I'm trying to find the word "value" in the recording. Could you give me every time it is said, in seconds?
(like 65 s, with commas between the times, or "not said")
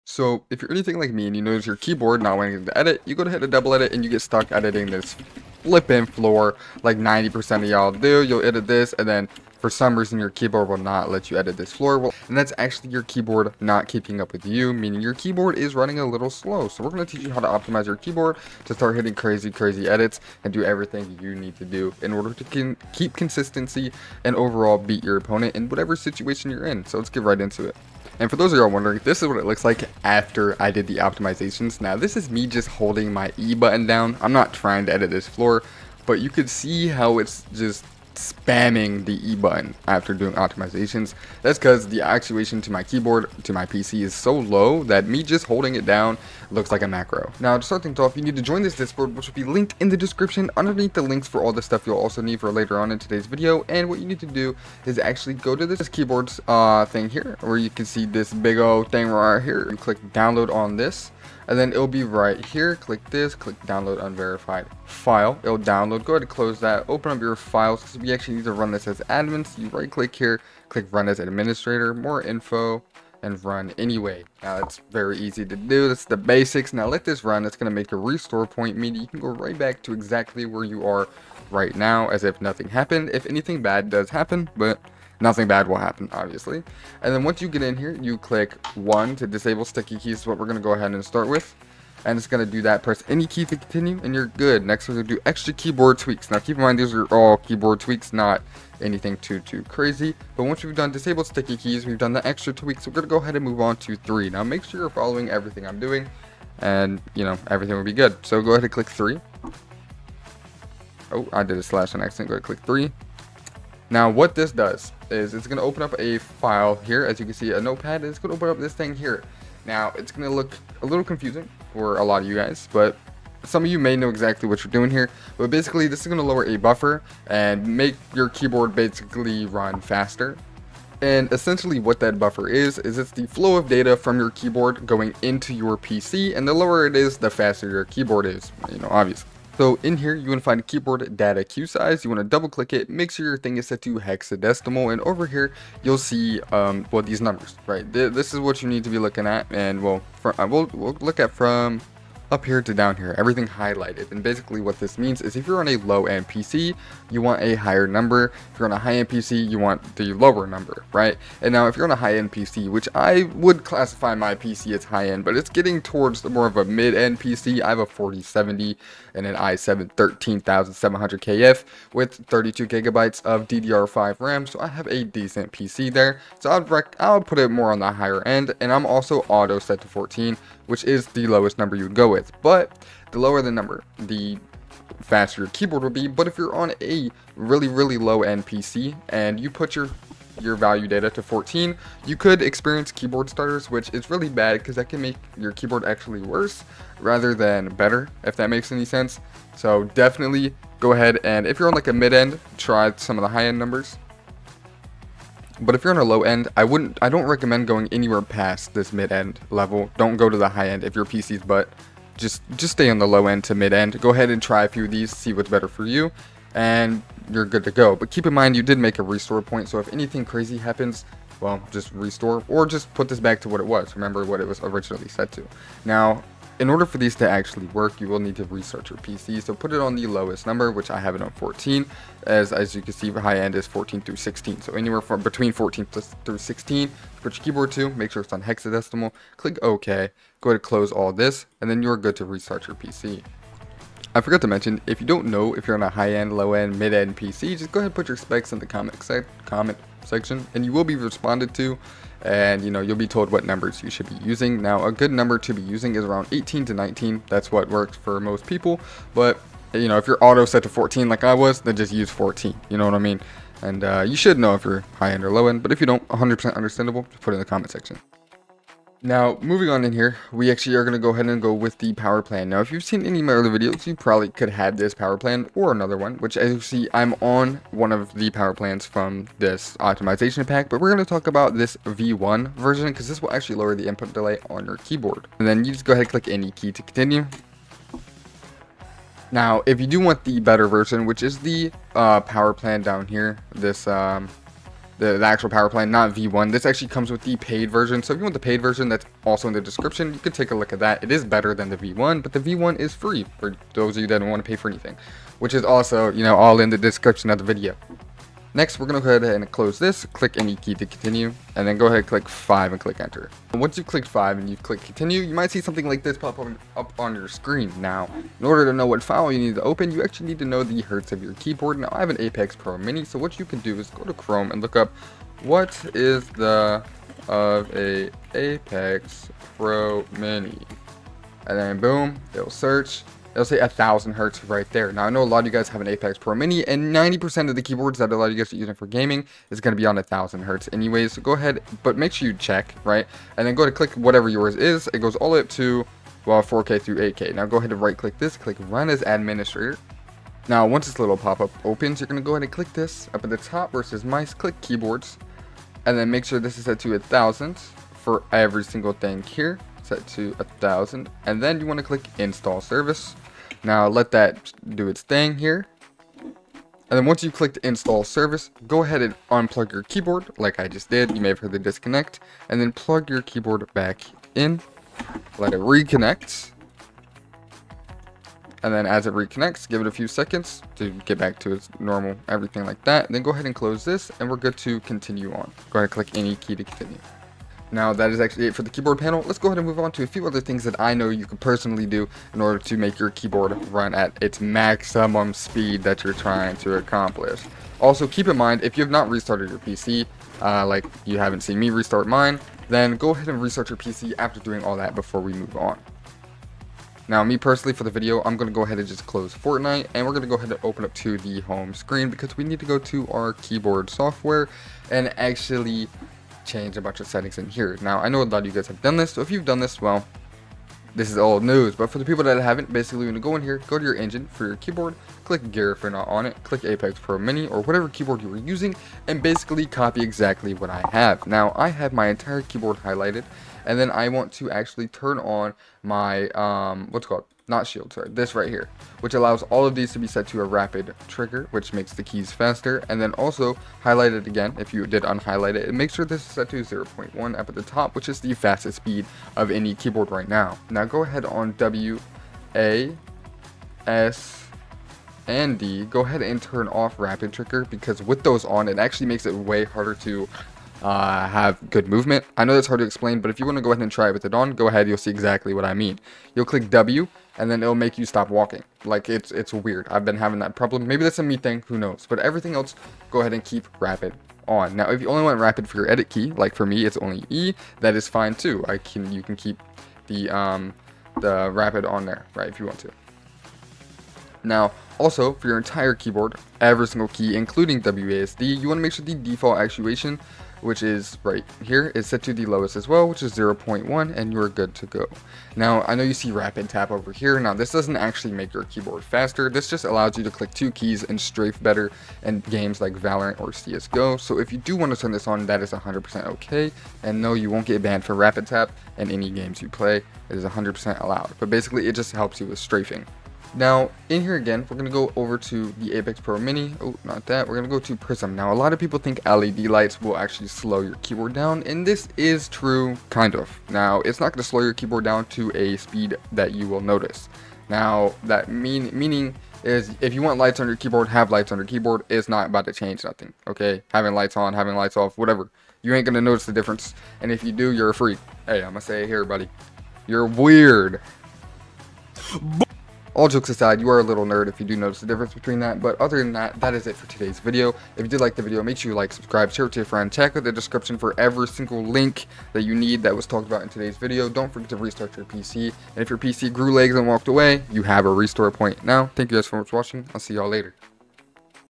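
190 s.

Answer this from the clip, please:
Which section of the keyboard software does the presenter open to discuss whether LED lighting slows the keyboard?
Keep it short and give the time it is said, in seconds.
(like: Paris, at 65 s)
Prism, at 517 s.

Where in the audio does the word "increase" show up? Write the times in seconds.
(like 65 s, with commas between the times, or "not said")
not said.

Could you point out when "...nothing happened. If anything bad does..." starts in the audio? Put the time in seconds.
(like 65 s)
82 s.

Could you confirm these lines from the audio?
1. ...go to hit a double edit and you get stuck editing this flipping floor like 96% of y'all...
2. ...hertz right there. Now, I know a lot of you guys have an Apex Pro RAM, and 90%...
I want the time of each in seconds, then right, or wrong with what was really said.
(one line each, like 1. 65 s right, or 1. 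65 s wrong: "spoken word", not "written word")
1. 3 s wrong: "90", not "96"
2. 334 s wrong: "Mini", not "RAM".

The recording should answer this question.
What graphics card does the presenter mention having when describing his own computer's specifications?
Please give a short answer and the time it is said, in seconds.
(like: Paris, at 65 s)
4070, at 167 s.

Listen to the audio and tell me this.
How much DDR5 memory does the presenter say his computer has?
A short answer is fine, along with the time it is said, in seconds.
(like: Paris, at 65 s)
32 gigabytes, at 172 s.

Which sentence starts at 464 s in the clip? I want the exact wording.
You'll see exactly what I mean.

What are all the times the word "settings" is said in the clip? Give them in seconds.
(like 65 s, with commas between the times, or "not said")
417 s.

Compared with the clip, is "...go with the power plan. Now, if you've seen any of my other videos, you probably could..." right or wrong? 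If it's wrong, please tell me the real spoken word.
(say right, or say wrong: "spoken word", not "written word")
right.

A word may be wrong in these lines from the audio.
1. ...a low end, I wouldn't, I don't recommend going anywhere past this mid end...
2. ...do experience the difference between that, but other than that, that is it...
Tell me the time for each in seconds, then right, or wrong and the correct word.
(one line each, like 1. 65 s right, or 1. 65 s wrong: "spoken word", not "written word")
1. 205 s right
2. 544 s wrong: "notice", not "experience".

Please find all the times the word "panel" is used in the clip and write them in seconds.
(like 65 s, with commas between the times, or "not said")
388 s.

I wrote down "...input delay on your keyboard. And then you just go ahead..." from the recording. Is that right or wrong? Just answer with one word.
right.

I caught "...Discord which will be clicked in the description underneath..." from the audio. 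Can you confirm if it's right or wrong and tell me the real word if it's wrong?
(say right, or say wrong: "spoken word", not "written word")
wrong: "linked", not "clicked".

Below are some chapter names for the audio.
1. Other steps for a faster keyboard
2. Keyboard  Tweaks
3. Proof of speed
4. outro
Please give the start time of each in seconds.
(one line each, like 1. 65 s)
1. 410 s
2. 47 s
3. 26 s
4. 542 s.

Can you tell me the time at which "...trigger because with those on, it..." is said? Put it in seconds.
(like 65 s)
457 s.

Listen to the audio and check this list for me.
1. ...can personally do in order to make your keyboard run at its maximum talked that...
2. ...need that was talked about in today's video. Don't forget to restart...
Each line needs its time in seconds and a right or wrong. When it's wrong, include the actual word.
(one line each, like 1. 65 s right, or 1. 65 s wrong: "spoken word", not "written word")
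1. 391 s wrong: "speed", not "talked"
2. 552 s right.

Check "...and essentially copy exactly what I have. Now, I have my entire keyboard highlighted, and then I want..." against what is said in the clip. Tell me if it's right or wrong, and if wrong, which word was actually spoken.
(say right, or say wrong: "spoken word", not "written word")
wrong: "basically", not "essentially".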